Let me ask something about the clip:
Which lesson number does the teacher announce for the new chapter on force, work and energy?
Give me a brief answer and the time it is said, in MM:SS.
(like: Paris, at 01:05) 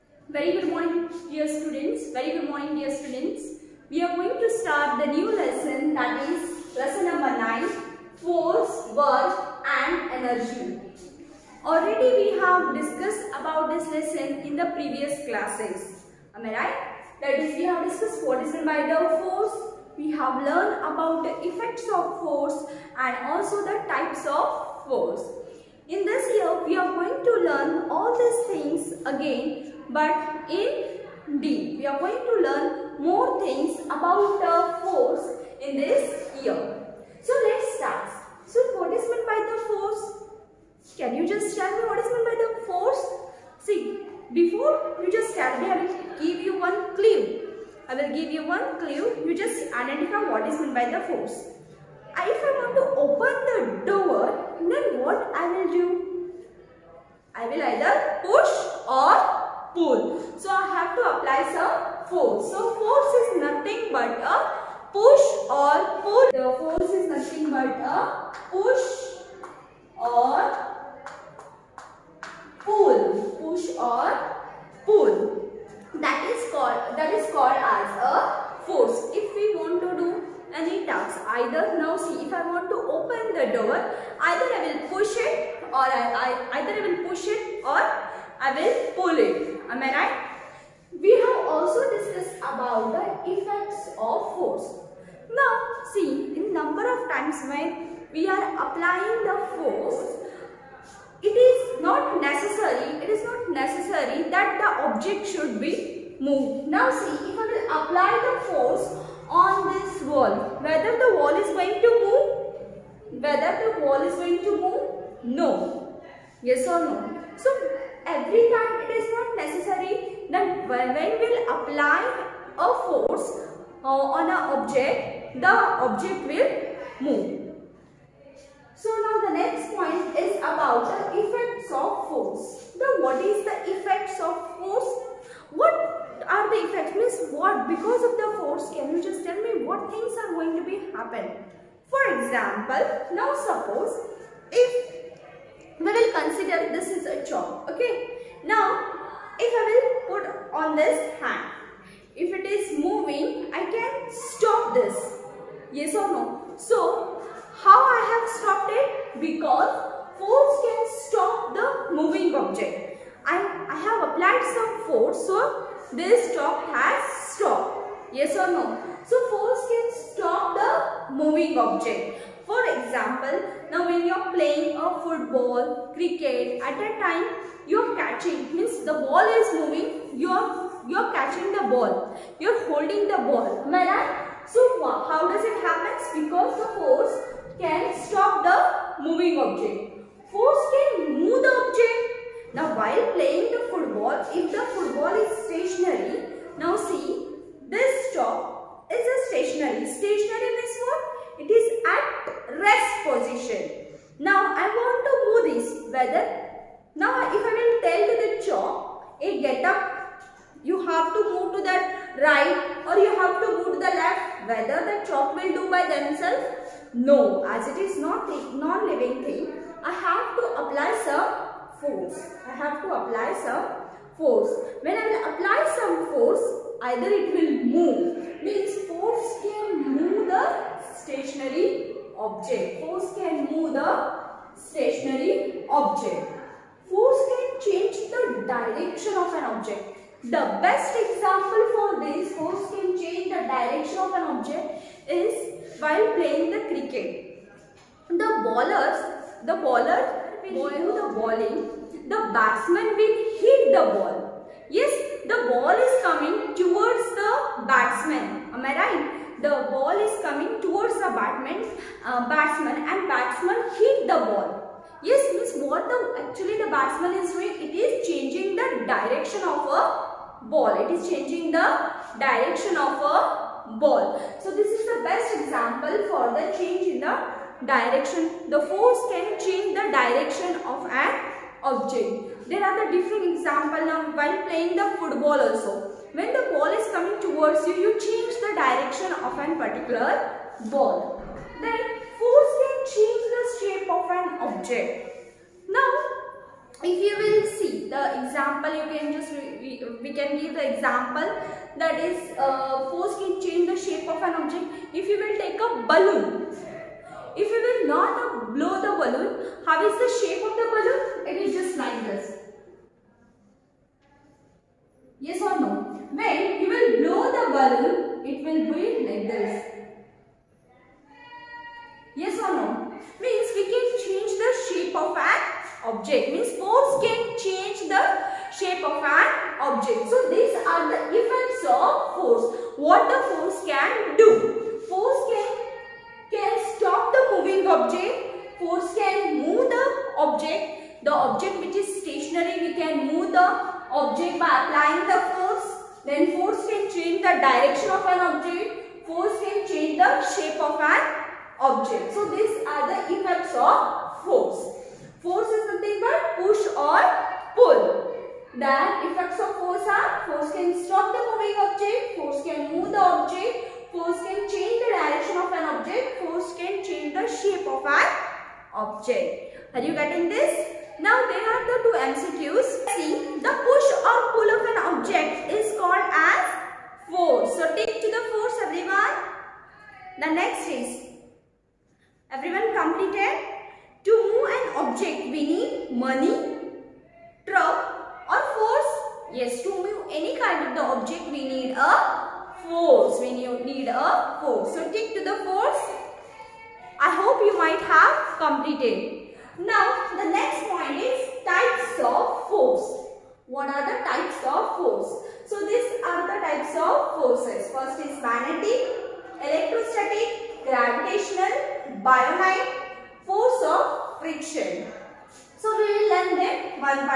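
9, at 00:06.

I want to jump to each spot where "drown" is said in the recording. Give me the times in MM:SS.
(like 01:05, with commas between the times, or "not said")
not said.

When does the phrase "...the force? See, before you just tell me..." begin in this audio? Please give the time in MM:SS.
00:42.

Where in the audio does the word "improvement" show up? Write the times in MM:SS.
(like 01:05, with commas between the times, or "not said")
not said.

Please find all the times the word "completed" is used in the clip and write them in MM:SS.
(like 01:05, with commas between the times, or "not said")
06:22, 06:38.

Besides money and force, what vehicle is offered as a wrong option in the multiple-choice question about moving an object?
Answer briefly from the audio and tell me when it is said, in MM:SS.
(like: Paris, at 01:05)
Truck, at 06:27.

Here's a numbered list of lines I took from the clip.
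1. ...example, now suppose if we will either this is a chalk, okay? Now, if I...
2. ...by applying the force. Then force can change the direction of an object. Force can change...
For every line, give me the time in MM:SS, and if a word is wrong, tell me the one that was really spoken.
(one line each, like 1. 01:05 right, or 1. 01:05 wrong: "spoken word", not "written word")
1. 02:22 wrong: "consider", not "either"
2. 05:44 right.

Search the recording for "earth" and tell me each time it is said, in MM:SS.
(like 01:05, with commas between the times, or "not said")
not said.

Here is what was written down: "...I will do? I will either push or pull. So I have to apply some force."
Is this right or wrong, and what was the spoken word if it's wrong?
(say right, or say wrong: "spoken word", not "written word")
right.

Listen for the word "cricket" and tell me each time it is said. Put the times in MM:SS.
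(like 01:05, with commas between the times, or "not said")
02:55, 04:06.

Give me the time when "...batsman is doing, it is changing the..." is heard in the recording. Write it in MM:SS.
04:26.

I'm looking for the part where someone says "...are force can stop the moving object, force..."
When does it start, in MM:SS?
05:59.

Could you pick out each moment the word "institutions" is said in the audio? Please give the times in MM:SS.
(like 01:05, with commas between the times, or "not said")
not said.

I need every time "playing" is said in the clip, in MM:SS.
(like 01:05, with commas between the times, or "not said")
02:54, 03:13, 04:06, 04:44.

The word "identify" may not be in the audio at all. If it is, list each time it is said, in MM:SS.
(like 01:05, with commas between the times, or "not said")
00:49.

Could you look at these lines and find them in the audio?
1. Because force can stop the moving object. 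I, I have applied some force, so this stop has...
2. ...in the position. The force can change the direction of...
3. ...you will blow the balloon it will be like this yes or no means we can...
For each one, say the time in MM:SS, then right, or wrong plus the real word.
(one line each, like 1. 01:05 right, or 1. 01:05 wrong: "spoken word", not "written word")
1. 02:39 right
2. 04:36 wrong: "direction", not "position"
3. 05:16 right.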